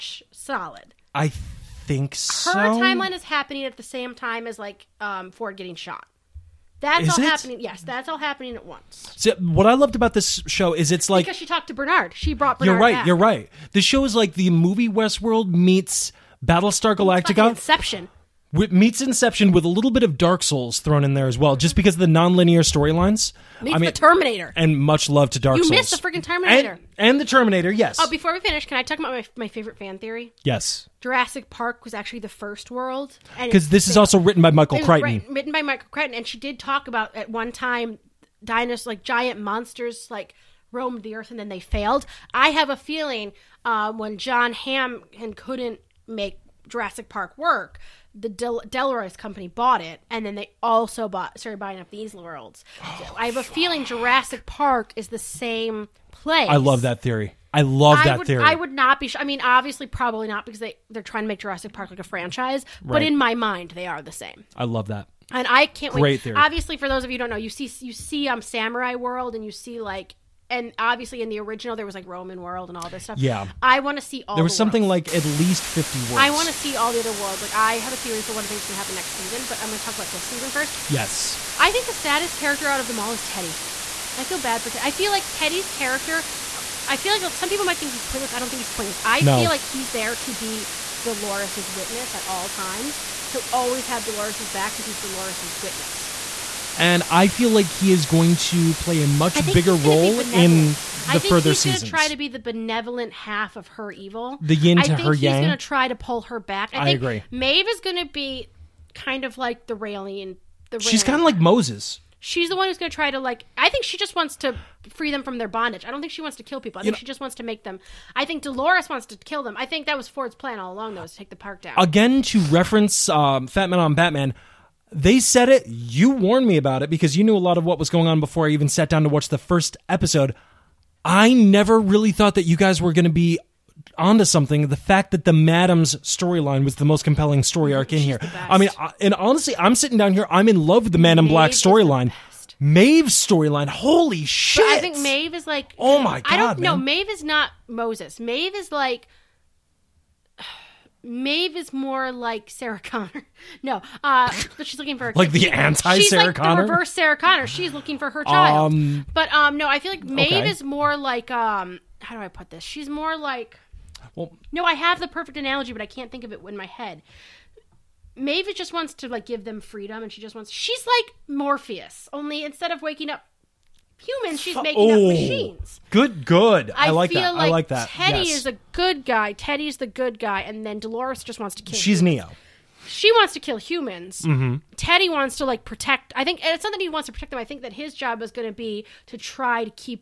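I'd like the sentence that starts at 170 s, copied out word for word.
She's like Morpheus, only instead of waking up Humans.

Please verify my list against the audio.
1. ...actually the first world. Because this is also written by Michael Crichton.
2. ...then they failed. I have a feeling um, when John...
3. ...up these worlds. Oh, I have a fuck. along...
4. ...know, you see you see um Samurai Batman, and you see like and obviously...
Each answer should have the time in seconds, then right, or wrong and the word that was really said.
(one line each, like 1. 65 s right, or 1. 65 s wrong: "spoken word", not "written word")
1. 31 s right
2. 41 s right
3. 51 s wrong: "feeling", not "along"
4. 67 s wrong: "World", not "Batman".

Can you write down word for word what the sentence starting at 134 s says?
The fact that the Madam's storyline was the most compelling story arc in She's here.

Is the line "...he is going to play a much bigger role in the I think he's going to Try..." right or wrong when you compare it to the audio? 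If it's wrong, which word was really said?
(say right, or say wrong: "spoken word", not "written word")
right.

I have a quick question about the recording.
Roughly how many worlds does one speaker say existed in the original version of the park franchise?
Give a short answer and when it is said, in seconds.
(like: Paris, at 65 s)
50, at 75 s.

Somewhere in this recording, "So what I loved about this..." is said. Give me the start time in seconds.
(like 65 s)
9 s.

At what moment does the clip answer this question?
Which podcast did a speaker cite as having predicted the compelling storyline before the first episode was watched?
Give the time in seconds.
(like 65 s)
123 s.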